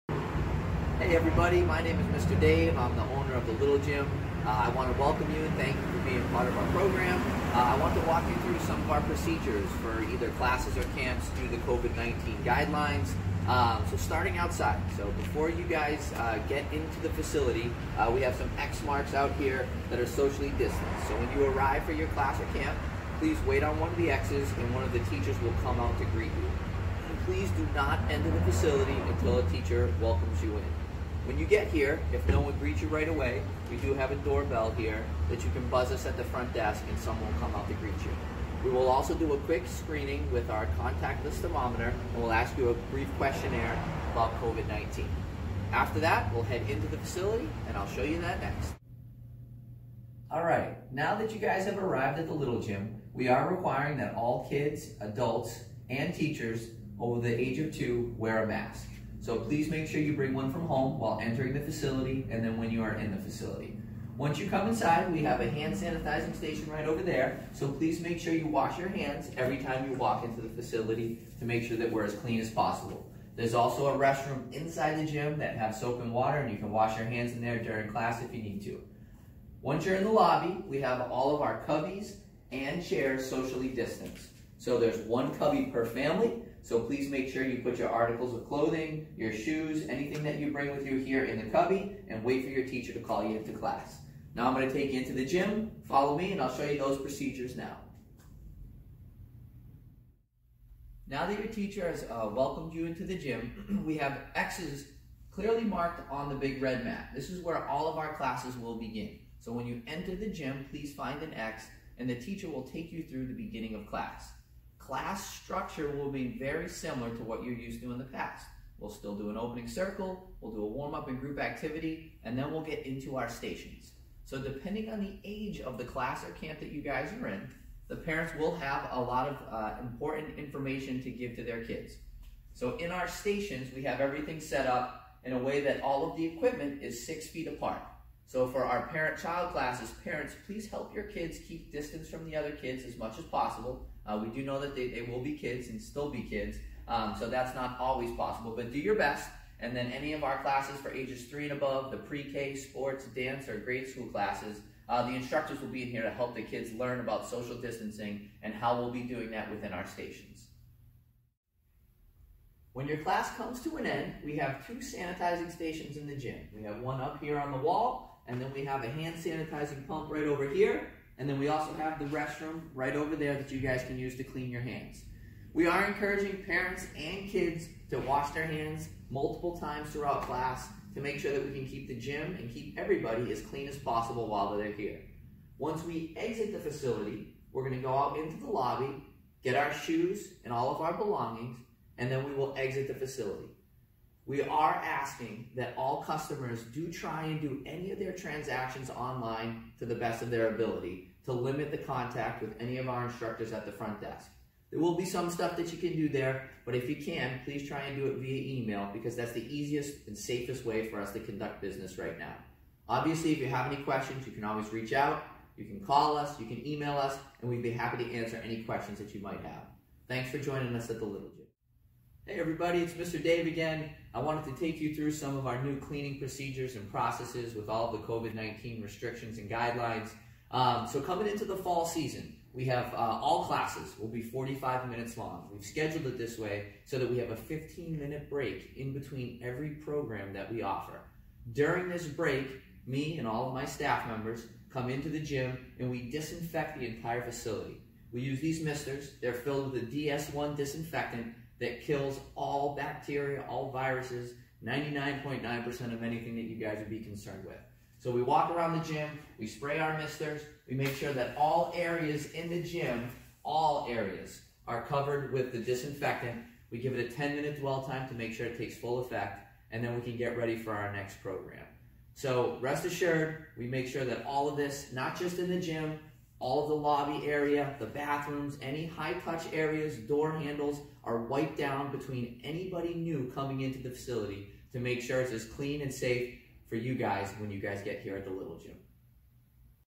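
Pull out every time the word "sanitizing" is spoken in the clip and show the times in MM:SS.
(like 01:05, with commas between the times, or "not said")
01:05, 02:44, 02:49.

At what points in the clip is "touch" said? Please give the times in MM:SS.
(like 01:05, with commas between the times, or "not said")
04:39.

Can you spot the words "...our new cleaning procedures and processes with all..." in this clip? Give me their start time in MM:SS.
03:45.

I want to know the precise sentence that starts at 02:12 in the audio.
So in our stations, we have everything set up in a way that all of the equipment is six feet apart.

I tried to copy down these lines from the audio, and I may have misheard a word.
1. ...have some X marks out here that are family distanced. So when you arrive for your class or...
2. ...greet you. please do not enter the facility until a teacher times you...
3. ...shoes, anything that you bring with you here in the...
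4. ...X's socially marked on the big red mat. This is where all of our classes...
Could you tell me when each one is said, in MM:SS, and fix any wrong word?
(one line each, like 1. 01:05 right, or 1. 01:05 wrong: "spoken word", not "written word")
1. 00:18 wrong: "socially", not "family"
2. 00:26 wrong: "welcomes", not "times"
3. 01:29 right
4. 01:44 wrong: "clearly", not "socially".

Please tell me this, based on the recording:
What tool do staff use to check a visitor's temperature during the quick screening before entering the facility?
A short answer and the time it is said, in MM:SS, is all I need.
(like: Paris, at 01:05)
Contactless thermometer, at 00:40.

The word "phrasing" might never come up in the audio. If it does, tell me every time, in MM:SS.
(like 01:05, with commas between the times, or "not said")
not said.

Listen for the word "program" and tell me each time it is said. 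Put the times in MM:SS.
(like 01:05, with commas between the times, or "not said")
00:06, 03:59, 04:31.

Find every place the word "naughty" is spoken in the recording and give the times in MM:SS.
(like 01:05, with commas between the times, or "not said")
not said.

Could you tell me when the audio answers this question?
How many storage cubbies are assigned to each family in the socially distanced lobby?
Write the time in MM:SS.
01:25.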